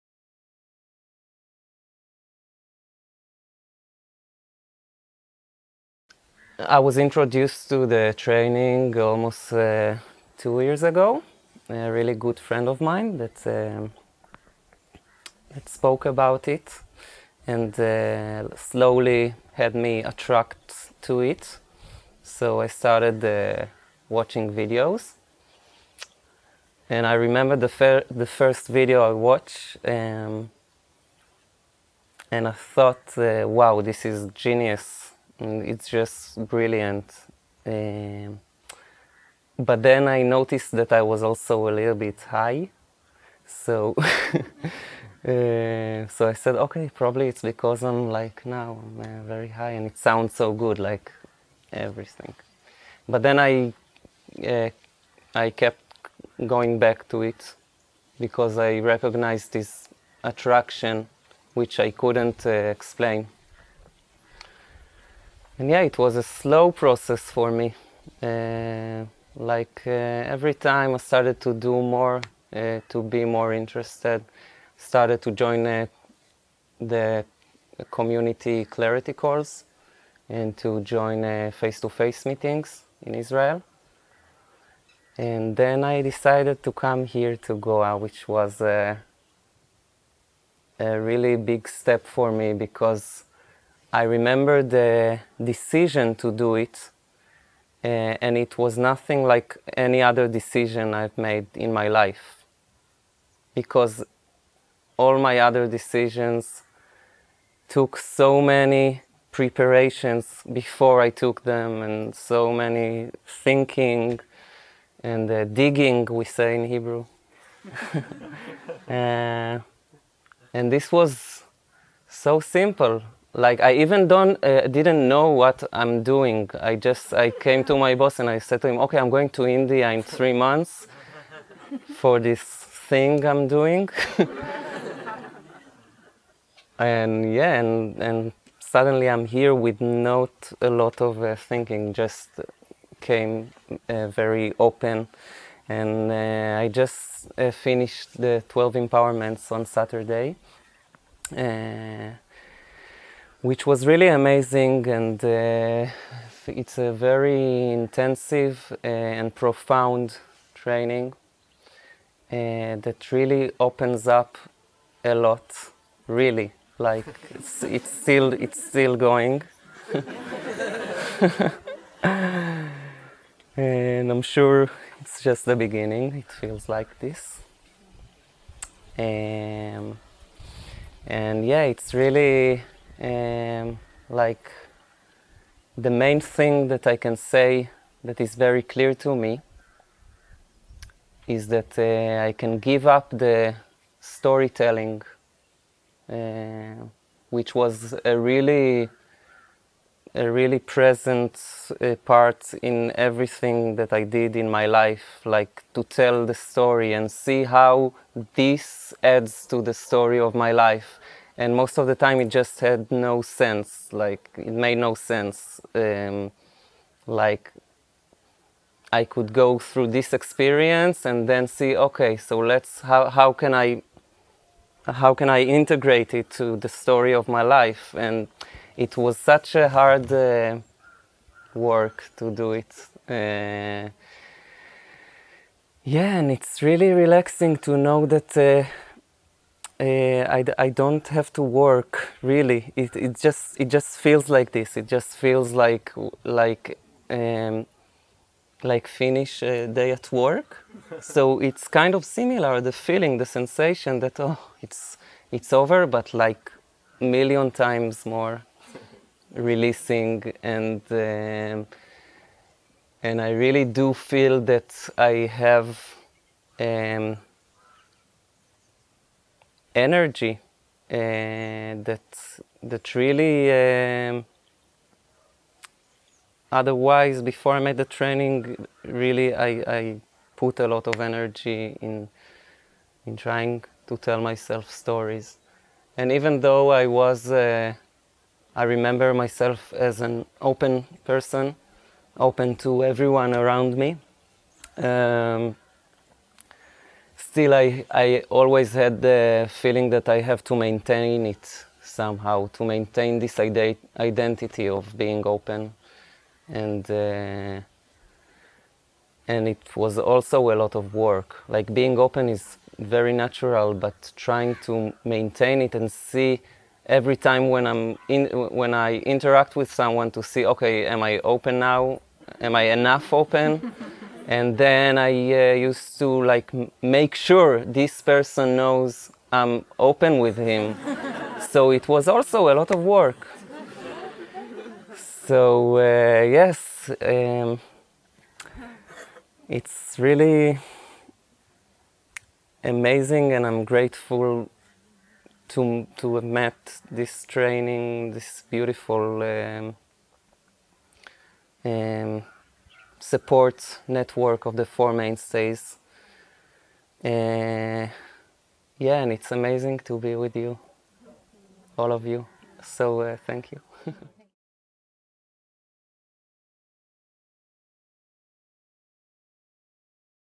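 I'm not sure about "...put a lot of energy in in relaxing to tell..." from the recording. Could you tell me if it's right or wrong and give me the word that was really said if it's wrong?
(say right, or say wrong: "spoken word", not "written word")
wrong: "trying", not "relaxing".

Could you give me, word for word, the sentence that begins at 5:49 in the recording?
Um, um, support network of the four mainstays.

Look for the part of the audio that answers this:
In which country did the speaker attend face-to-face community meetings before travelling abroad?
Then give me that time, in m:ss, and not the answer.
1:23.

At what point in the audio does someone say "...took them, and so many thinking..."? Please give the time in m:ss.
1:51.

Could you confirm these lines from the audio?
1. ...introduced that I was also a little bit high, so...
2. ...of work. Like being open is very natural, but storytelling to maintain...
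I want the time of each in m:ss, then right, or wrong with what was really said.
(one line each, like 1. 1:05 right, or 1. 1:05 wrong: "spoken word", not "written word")
1. 0:40 wrong: "noticed", not "introduced"
2. 5:10 wrong: "trying", not "storytelling".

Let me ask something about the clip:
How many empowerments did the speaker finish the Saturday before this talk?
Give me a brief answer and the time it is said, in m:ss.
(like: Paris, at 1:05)
12, at 2:28.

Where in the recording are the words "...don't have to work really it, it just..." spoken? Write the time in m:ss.
4:00.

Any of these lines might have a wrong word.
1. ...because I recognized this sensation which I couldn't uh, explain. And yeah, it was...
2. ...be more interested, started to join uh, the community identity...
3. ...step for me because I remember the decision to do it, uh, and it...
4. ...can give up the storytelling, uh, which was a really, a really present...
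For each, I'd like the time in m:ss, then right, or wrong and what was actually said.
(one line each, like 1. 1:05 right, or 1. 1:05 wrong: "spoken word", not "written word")
1. 0:58 wrong: "attraction", not "sensation"
2. 1:13 wrong: "clarity", not "identity"
3. 1:31 right
4. 3:12 right.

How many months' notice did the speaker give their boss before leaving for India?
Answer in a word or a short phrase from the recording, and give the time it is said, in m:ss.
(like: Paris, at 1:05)
3 months, at 2:10.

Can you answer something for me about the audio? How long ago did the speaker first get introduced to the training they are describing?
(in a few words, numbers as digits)
almost 2 years ago.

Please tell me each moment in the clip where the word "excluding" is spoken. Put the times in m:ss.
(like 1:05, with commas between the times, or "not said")
not said.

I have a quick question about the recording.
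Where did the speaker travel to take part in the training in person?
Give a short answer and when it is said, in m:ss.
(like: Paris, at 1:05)
Goa, at 1:27.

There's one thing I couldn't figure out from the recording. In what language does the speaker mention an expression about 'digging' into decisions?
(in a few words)
Hebrew.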